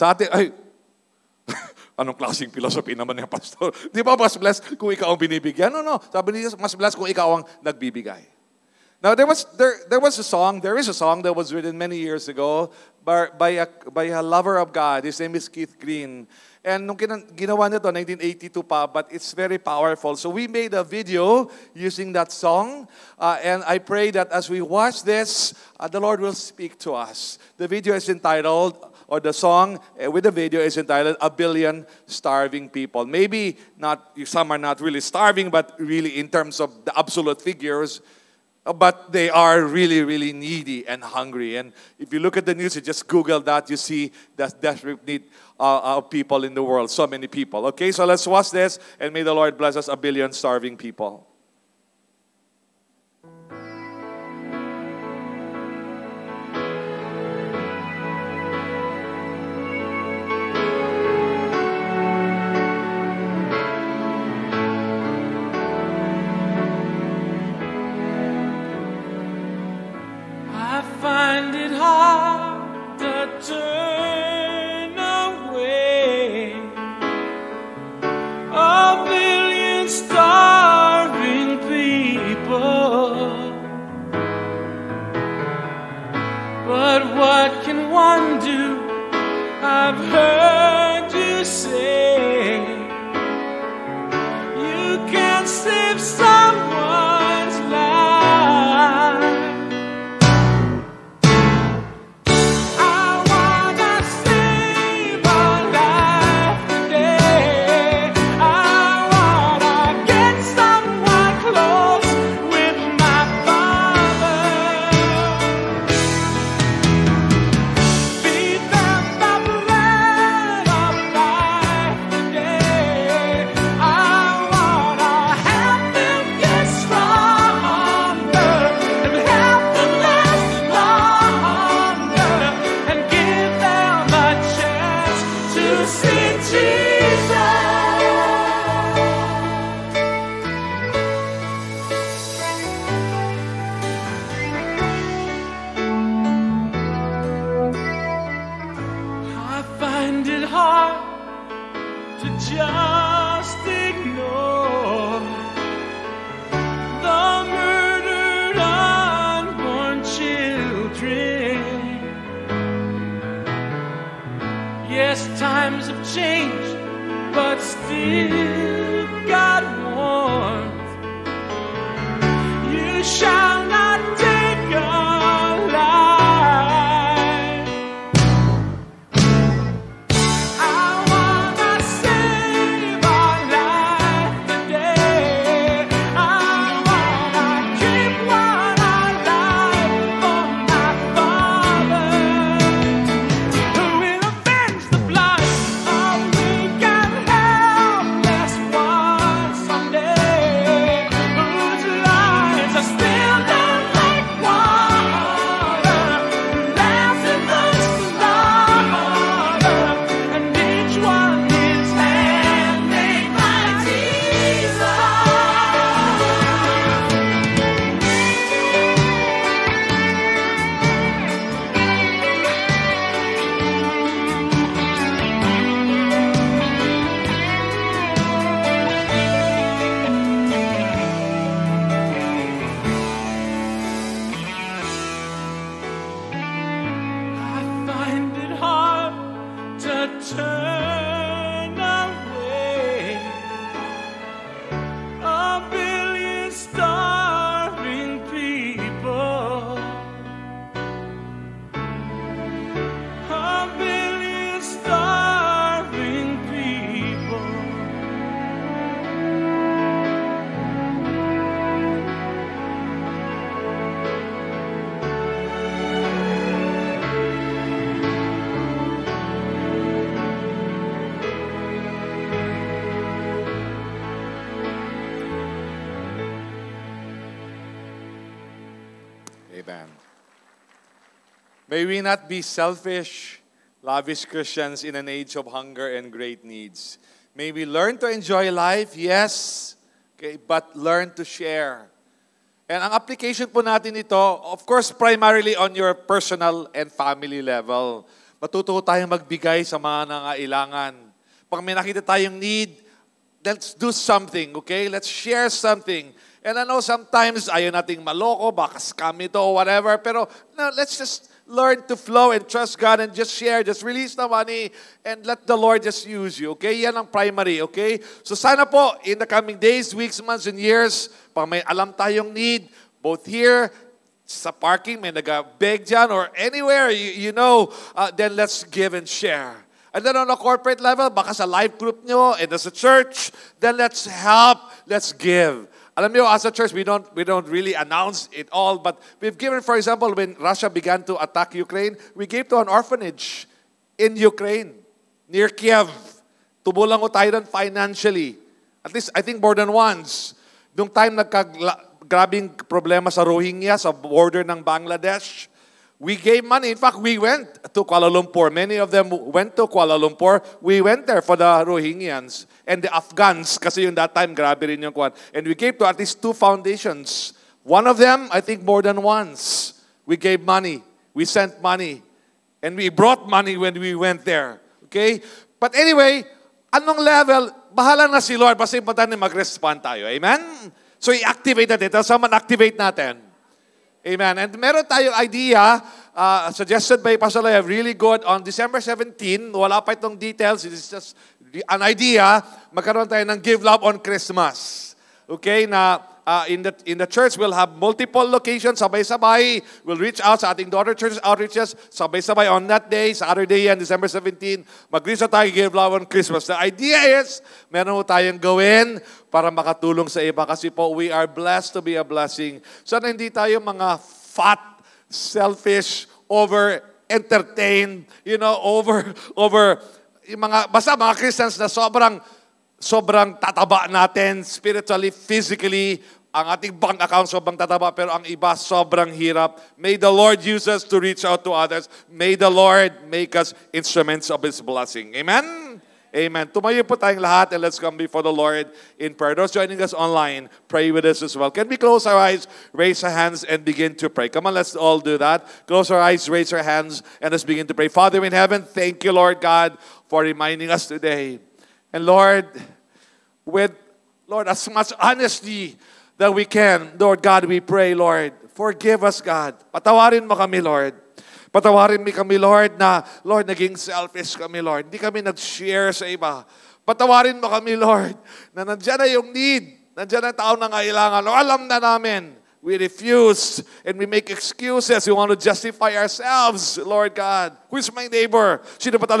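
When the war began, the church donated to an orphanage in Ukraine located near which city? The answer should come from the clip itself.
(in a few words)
Kiev.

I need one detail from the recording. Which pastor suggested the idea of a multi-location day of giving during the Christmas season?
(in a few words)
Pastor Lev.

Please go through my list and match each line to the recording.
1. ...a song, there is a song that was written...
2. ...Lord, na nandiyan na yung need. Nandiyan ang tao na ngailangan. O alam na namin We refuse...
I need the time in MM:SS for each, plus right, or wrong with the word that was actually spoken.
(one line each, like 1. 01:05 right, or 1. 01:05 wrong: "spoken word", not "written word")
1. 00:10 right
2. 07:47 right.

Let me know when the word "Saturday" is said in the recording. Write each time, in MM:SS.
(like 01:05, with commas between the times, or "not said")
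06:43.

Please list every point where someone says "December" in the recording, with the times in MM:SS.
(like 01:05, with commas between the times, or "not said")
06:28, 06:43.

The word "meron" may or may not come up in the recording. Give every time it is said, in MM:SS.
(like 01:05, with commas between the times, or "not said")
06:24, 06:47.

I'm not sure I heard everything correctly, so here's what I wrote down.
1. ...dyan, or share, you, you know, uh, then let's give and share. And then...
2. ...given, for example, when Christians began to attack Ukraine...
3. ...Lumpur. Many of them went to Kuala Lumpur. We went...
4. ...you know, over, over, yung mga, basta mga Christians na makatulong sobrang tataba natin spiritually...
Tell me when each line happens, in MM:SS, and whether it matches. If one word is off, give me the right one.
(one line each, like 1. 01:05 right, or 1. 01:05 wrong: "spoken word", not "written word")
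1. 05:25 wrong: "anywhere", not "share"
2. 05:39 wrong: "Russia", not "Christians"
3. 05:58 right
4. 06:58 wrong: "sobrang", not "makatulong".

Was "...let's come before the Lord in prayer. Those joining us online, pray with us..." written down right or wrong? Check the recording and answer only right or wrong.
right.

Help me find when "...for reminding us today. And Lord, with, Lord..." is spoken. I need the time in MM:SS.
07:30.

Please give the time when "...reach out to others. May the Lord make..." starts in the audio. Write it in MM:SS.
07:11.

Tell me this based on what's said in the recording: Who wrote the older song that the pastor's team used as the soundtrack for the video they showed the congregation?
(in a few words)
Keith Green.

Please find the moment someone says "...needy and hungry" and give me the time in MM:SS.
00:40.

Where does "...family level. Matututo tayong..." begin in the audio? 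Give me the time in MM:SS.
04:56.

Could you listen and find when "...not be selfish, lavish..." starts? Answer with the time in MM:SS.
04:42.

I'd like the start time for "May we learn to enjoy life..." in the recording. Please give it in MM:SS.
04:47.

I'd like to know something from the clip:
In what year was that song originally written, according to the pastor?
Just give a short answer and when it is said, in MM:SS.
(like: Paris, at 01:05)
1982, at 00:17.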